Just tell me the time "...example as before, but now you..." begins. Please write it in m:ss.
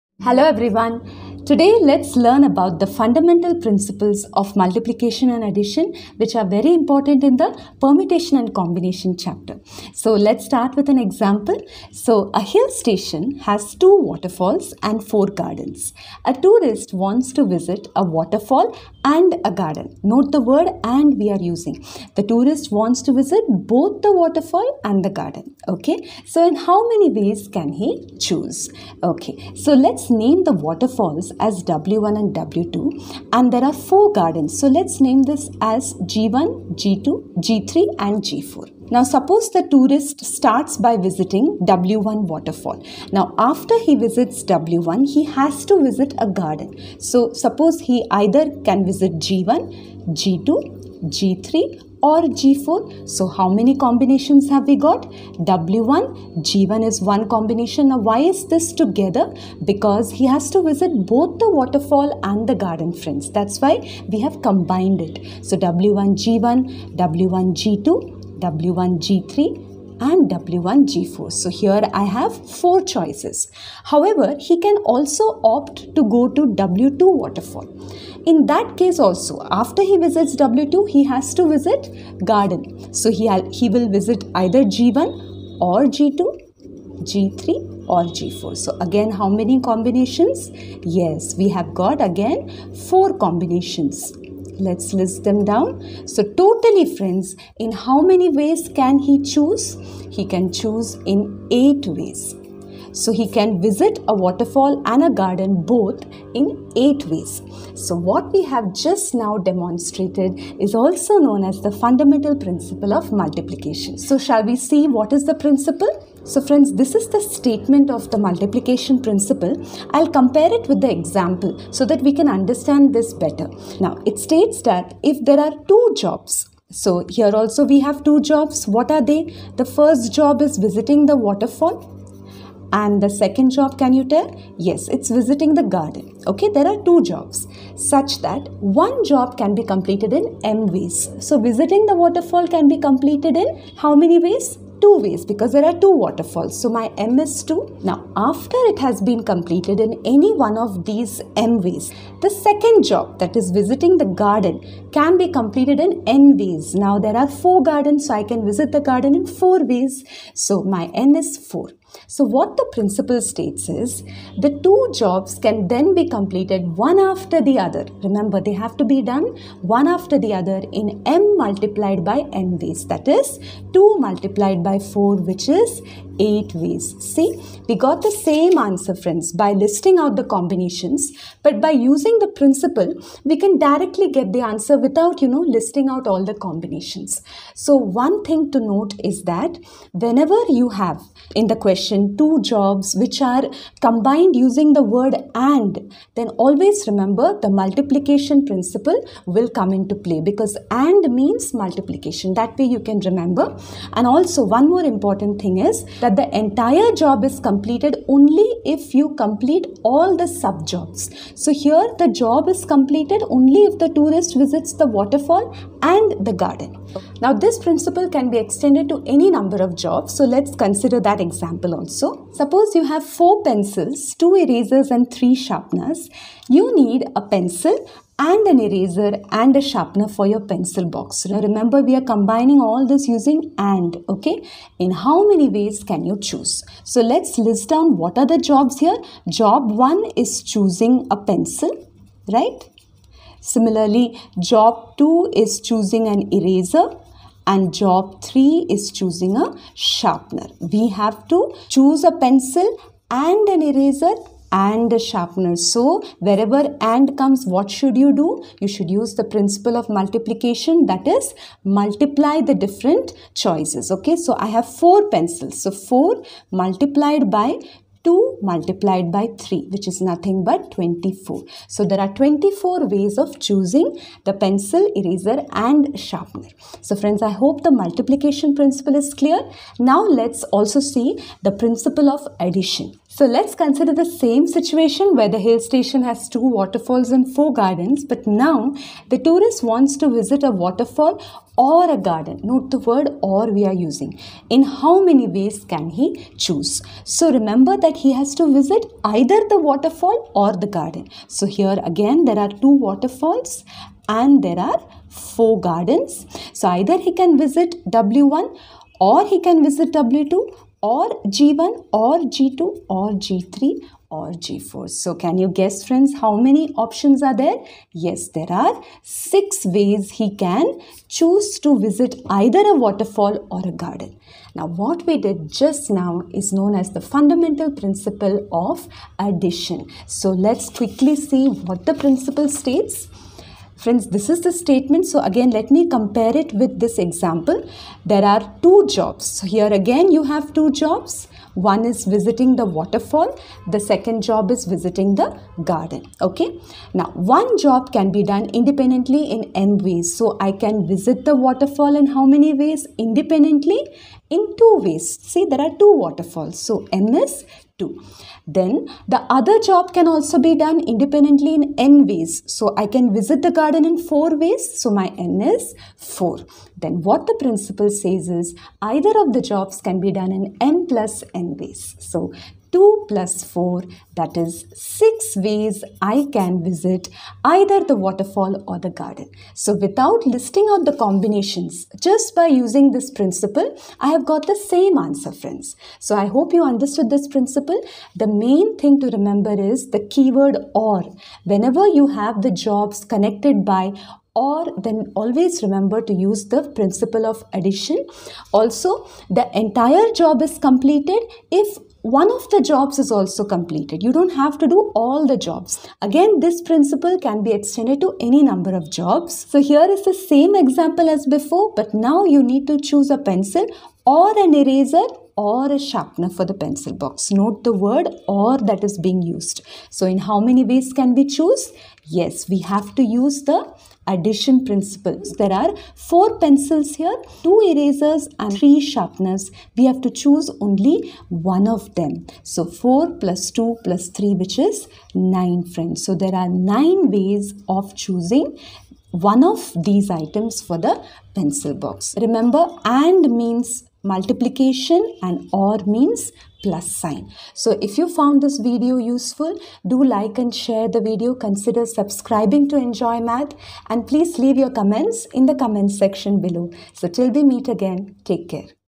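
6:50.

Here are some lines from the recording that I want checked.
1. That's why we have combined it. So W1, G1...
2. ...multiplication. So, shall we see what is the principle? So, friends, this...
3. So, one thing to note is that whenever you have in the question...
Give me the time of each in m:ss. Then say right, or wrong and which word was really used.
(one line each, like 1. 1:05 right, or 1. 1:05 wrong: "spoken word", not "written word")
1. 1:03 right
2. 1:53 right
3. 3:07 right.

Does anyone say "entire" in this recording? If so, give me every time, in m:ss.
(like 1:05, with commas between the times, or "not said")
3:26, 6:39.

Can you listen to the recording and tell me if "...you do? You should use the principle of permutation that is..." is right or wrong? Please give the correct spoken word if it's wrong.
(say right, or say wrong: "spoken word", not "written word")
wrong: "multiplication", not "permutation".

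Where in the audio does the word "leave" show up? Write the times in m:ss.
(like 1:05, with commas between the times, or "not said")
7:34.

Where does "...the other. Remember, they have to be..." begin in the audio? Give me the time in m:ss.
2:47.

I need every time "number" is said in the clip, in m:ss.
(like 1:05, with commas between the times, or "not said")
3:39, 6:48.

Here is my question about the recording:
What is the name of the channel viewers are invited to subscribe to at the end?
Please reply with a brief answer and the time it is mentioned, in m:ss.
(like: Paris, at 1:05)
Enjoy Math, at 7:32.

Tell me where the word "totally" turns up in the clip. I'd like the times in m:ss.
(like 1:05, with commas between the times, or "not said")
1:36.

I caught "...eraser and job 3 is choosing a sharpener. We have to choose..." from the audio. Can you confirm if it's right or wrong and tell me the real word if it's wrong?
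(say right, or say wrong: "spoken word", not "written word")
right.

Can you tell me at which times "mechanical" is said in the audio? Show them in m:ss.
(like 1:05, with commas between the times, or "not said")
not said.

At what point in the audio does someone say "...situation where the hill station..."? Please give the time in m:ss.
4:44.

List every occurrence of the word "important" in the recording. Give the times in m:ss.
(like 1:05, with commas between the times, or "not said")
0:06, 3:24.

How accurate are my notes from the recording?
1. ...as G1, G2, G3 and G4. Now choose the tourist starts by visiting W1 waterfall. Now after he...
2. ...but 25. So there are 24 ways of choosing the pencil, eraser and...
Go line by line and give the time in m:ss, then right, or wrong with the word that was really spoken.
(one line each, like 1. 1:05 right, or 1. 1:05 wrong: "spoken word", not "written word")
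1. 0:35 wrong: "suppose", not "choose"
2. 4:30 wrong: "24", not "25".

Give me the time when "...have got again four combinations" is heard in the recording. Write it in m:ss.
1:31.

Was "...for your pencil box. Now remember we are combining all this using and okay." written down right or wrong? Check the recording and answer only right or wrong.
right.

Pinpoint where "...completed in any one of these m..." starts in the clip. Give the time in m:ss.
2:29.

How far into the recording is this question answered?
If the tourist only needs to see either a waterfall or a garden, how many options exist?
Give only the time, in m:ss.
5:19.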